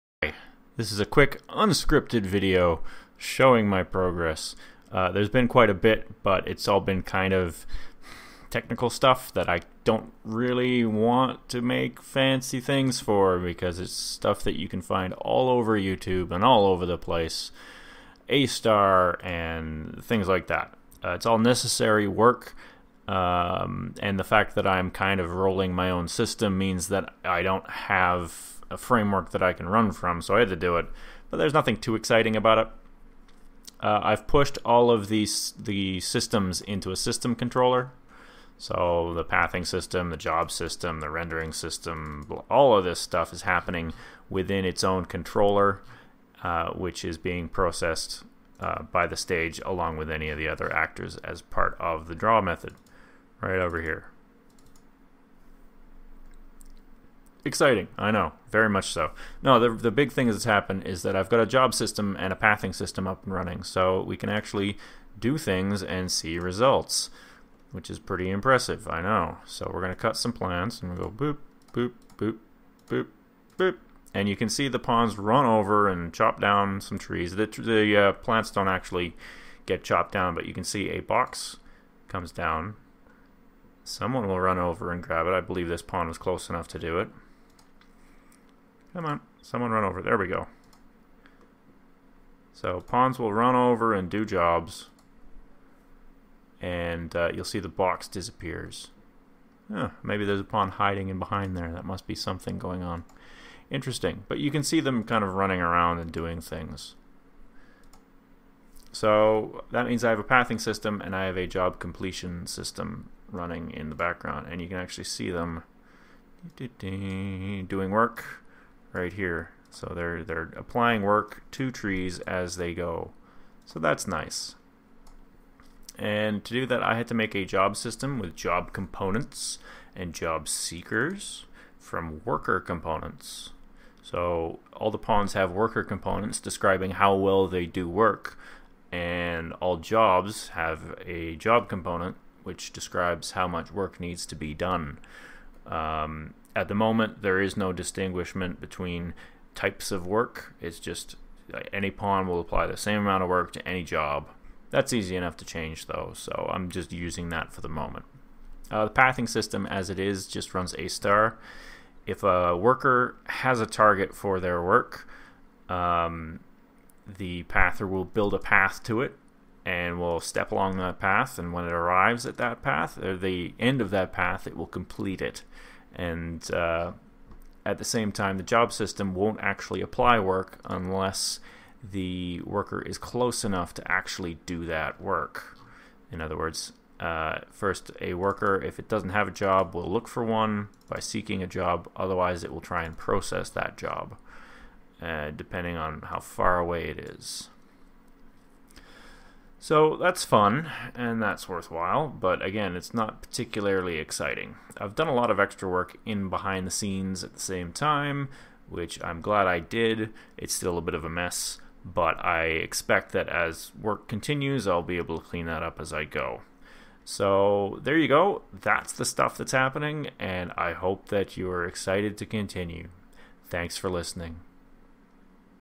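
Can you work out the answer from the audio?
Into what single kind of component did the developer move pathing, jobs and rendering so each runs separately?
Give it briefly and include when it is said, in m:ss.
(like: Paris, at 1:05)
system controller, at 0:36.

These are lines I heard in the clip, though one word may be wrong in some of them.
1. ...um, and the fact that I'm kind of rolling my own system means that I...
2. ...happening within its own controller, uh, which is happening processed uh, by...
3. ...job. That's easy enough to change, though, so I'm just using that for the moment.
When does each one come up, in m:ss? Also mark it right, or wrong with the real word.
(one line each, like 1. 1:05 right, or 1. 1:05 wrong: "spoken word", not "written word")
1. 0:23 right
2. 0:43 wrong: "being", not "happening"
3. 2:33 right.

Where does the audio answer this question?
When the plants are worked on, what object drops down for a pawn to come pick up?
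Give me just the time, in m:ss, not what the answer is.
1:20.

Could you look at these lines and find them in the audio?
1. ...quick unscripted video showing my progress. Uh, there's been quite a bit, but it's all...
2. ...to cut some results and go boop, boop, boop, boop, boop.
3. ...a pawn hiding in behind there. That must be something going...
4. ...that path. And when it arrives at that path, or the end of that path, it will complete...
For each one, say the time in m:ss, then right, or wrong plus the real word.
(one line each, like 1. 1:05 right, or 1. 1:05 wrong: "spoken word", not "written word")
1. 0:01 right
2. 1:09 wrong: "plants", not "results"
3. 1:40 right
4. 2:50 right.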